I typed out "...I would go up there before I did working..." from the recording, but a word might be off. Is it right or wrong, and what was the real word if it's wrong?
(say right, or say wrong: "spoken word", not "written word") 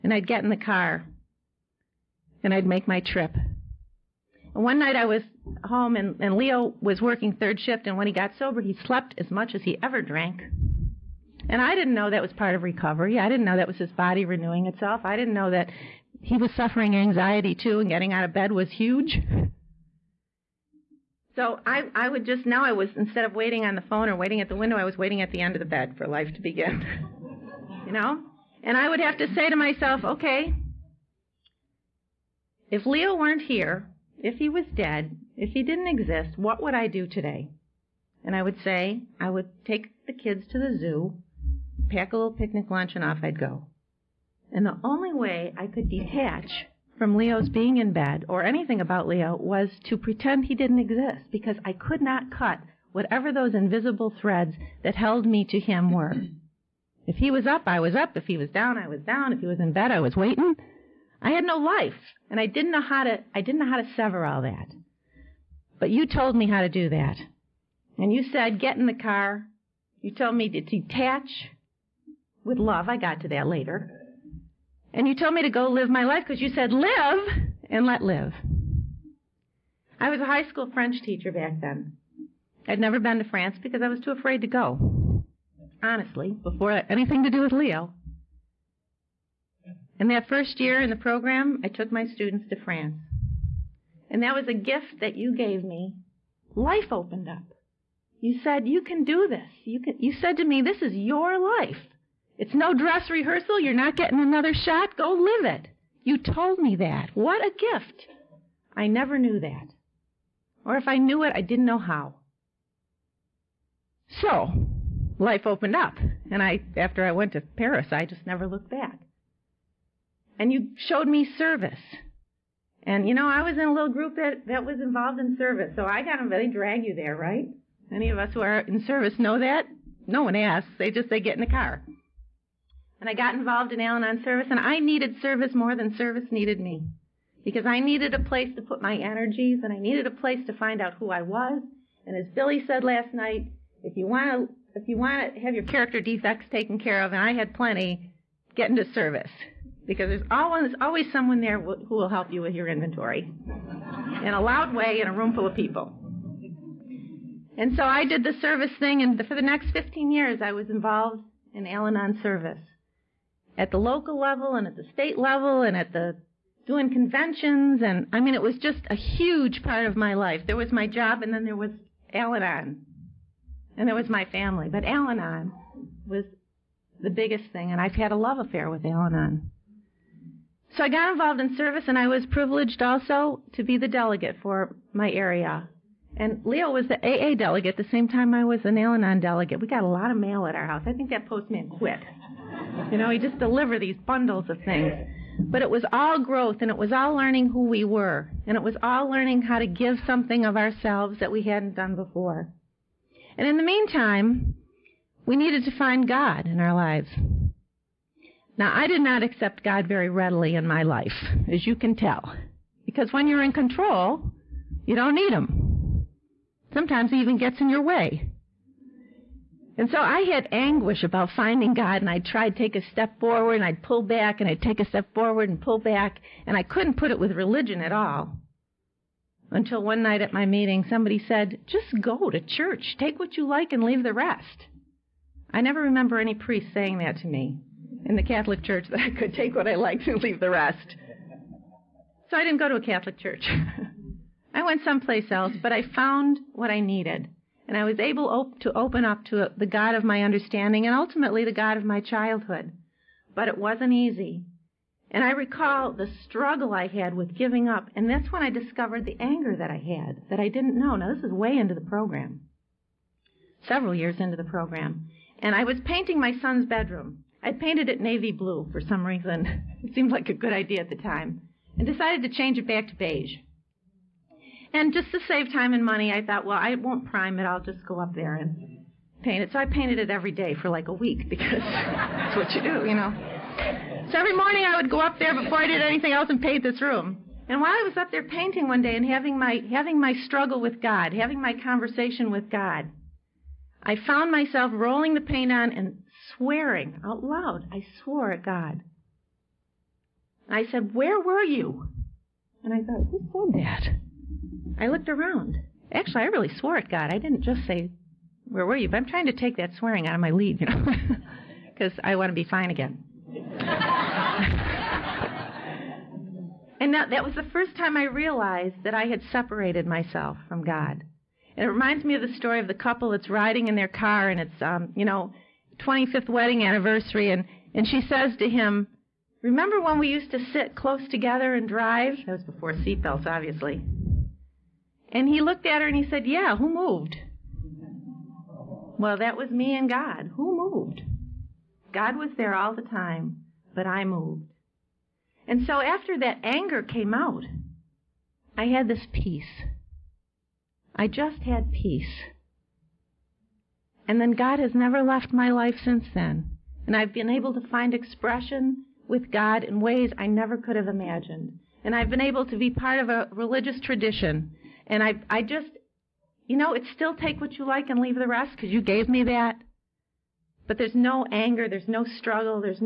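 wrong: "anything", not "working".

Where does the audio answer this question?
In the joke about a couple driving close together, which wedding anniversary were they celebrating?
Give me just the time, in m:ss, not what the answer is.
5:25.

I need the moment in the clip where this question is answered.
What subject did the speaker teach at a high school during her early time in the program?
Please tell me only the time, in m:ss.
1:20.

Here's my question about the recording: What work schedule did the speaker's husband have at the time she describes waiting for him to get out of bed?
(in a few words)
Third shift.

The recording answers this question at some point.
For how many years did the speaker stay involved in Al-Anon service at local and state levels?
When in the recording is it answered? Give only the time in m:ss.
2:39.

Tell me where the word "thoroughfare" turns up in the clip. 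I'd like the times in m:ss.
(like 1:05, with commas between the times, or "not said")
not said.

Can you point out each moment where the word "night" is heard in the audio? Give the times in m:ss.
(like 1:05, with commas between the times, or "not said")
0:04, 2:23, 3:50.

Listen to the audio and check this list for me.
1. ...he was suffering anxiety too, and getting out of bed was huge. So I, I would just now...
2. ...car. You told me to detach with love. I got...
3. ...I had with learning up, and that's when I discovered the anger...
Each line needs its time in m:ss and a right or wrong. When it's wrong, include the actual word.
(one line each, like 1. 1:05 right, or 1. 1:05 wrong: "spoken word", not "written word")
1. 0:16 right
2. 1:08 right
3. 4:16 wrong: "giving", not "learning".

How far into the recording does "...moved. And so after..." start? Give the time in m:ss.
5:44.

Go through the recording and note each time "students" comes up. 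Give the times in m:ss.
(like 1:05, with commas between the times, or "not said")
1:32.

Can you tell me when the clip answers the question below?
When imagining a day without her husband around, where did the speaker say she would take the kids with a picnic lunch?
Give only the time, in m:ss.
0:40.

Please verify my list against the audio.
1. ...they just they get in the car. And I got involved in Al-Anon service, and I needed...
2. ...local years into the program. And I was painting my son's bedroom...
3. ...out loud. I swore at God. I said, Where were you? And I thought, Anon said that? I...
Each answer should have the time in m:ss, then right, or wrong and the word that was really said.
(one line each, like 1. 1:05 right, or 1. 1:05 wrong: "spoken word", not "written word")
1. 2:10 right
2. 4:23 wrong: "several", not "local"
3. 4:57 wrong: "Who", not "Anon".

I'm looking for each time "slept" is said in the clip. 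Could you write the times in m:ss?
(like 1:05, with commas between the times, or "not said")
0:08.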